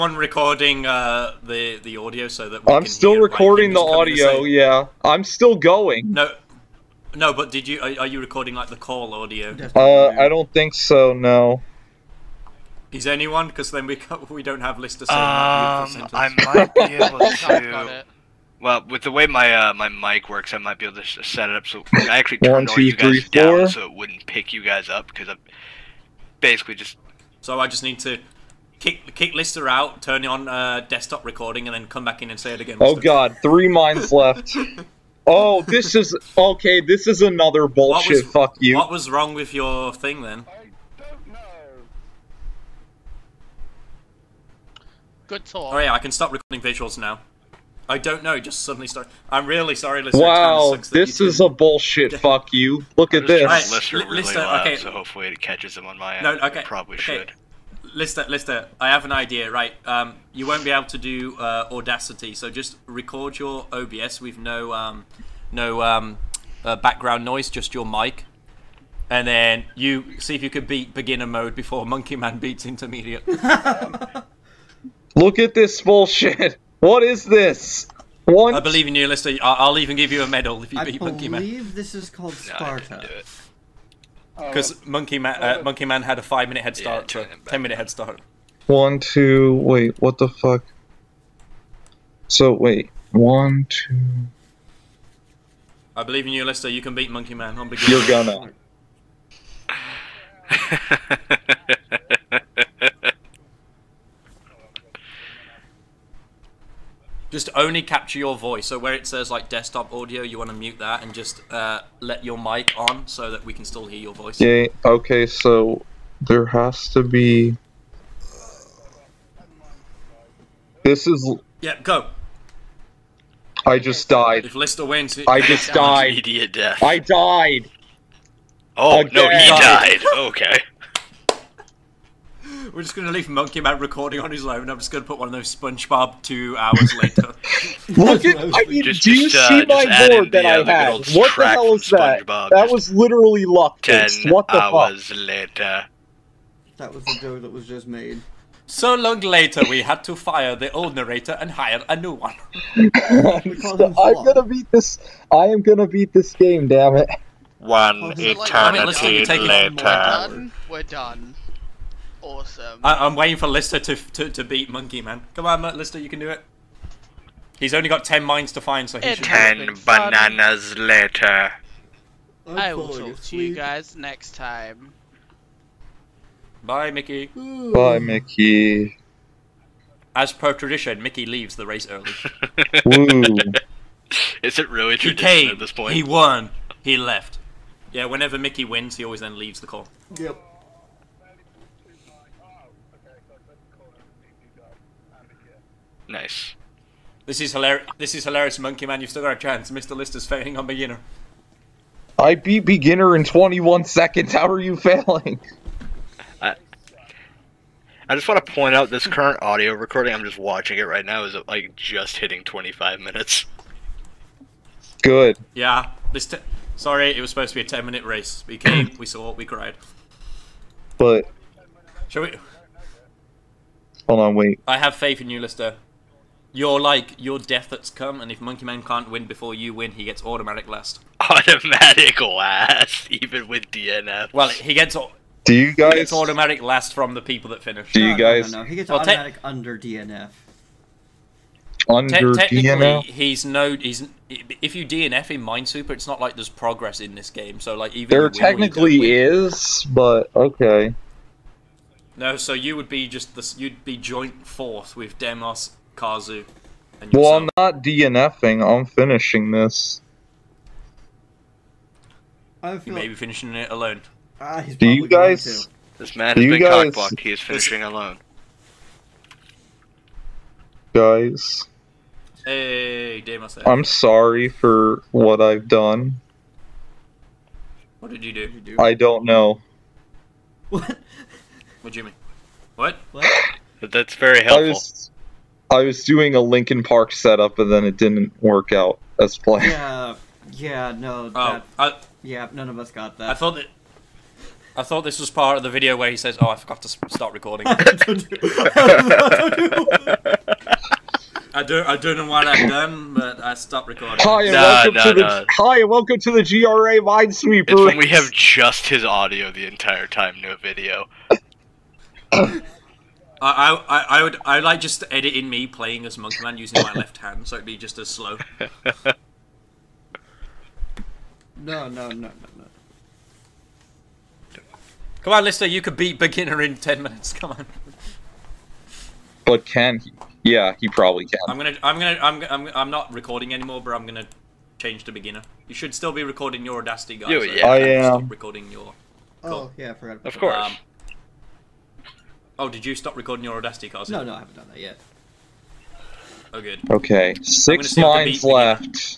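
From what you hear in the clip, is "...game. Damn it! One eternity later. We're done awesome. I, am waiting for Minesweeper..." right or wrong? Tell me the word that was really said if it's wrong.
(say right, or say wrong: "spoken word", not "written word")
wrong: "Lister", not "Minesweeper".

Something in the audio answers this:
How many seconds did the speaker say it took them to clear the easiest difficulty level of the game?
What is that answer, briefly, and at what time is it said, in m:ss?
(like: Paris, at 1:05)
21, at 3:23.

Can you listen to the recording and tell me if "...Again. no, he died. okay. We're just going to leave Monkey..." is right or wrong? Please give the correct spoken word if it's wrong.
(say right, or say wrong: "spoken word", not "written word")
right.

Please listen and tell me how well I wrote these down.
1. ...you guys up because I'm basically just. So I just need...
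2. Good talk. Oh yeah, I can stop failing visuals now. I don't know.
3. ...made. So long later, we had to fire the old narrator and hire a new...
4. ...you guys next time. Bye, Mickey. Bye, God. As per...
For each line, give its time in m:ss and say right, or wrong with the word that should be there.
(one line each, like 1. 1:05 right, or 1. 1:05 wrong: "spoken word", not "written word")
1. 0:24 right
2. 0:45 wrong: "recording", not "failing"
3. 2:27 right
4. 2:53 wrong: "Mickey", not "God".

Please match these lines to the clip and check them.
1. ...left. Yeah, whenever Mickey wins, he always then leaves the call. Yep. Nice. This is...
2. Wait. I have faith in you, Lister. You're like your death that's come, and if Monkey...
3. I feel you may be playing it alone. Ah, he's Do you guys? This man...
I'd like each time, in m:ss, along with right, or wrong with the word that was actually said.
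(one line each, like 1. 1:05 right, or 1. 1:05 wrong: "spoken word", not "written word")
1. 3:06 right
2. 3:44 right
3. 4:22 wrong: "finishing", not "playing".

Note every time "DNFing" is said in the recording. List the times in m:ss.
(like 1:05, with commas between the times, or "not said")
4:17.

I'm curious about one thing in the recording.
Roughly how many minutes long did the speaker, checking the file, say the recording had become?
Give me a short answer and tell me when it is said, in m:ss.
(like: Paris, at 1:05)
25, at 3:32.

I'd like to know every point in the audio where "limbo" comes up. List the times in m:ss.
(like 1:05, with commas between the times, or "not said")
not said.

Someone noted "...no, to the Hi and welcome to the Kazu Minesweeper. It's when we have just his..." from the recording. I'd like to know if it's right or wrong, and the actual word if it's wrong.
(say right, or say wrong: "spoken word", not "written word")
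wrong: "GRA", not "Kazu".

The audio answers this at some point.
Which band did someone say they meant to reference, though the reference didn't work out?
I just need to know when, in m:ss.
4:46.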